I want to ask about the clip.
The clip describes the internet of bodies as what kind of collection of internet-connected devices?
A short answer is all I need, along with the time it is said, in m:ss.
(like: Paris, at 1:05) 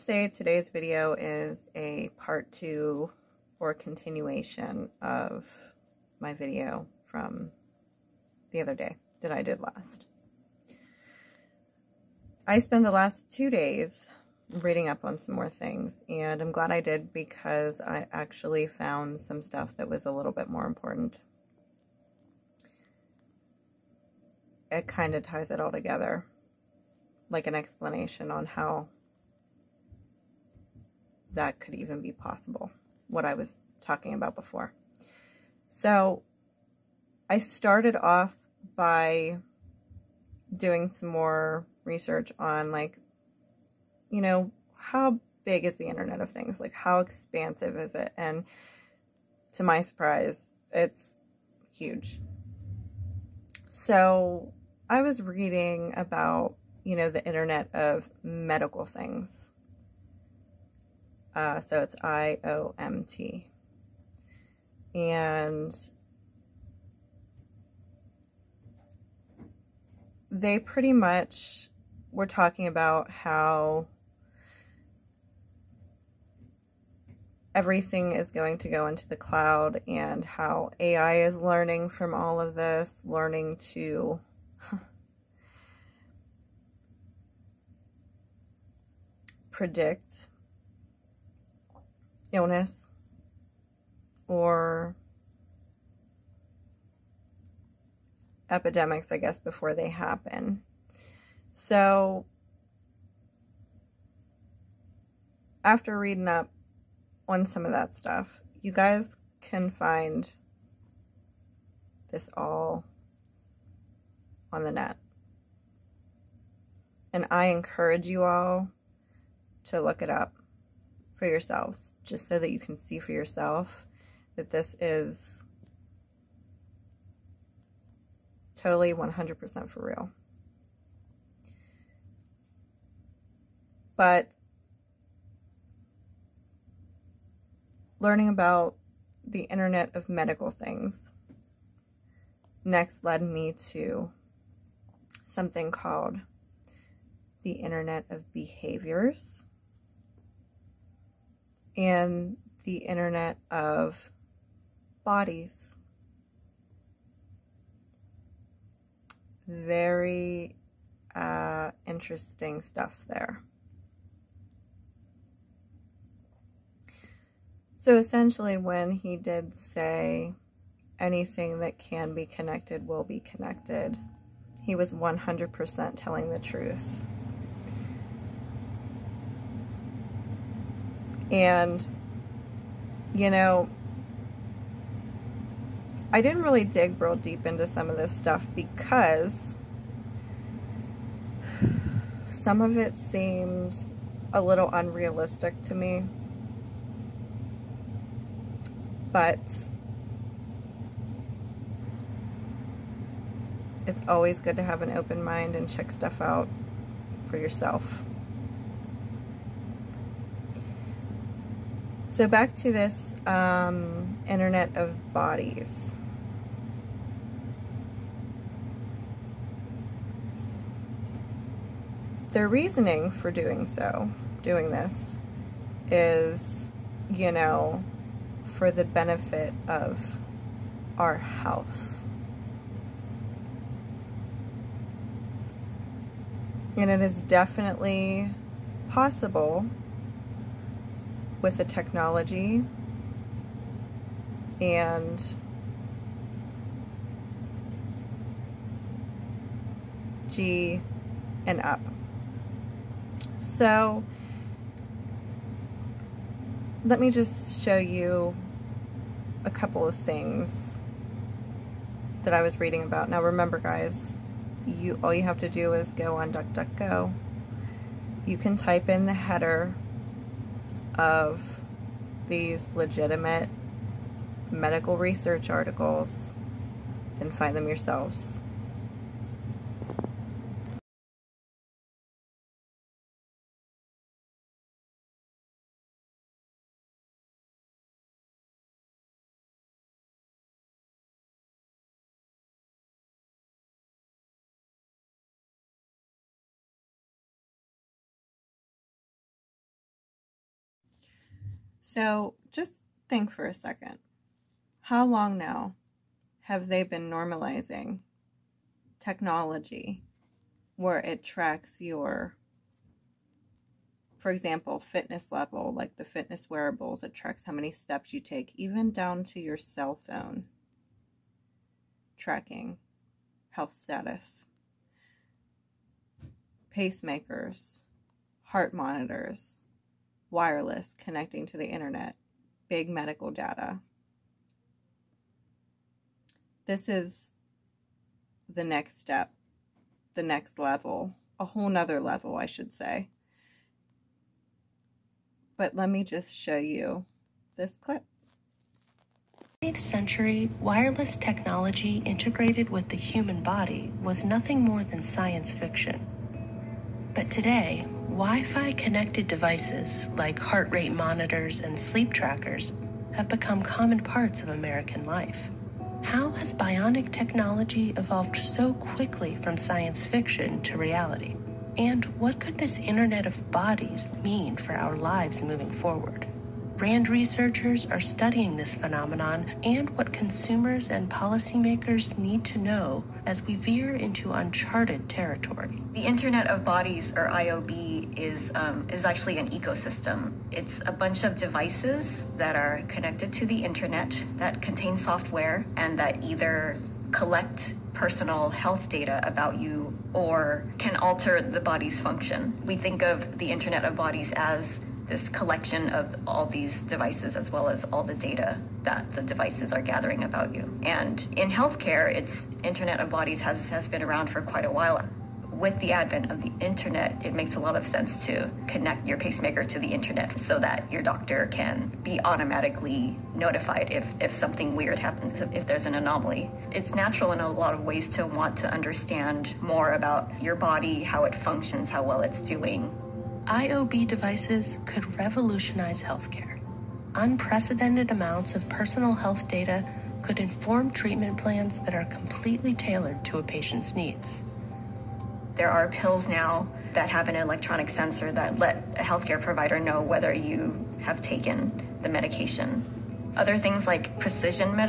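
ecosystem, at 6:29.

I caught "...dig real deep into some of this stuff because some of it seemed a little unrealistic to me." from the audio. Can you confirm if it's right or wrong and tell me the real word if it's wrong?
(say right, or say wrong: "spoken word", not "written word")
right.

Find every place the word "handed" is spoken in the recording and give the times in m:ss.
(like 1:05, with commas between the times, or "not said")
not said.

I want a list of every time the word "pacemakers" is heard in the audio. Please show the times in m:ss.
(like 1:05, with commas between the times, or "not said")
5:26, 6:59.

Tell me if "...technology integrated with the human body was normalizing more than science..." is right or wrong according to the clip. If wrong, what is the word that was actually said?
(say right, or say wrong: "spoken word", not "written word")
wrong: "nothing", not "normalizing".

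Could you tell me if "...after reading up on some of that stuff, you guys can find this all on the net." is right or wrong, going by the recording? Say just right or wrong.
right.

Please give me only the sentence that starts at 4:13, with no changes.
So let me just show you a couple of things that I was reading about.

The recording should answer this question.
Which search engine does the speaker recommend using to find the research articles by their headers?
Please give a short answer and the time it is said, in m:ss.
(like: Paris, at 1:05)
DuckDuckGo, at 4:26.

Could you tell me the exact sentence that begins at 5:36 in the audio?
This is the next step, the next level, a whole nother level, I should say.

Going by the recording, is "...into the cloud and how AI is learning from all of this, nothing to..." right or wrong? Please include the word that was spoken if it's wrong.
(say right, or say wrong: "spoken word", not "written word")
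wrong: "learning", not "nothing".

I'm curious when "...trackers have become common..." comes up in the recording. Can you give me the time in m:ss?
6:02.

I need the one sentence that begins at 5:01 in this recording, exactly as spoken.
So just think for a second.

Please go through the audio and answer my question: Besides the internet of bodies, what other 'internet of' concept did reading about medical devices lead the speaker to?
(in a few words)
internet of behaviors.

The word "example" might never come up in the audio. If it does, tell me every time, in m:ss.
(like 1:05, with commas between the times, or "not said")
5:14.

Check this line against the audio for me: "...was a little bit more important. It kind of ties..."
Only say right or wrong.
right.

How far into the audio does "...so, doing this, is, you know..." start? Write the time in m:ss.
3:43.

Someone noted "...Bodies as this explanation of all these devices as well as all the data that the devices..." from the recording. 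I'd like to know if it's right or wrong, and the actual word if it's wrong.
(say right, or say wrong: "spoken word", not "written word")
wrong: "collection", not "explanation".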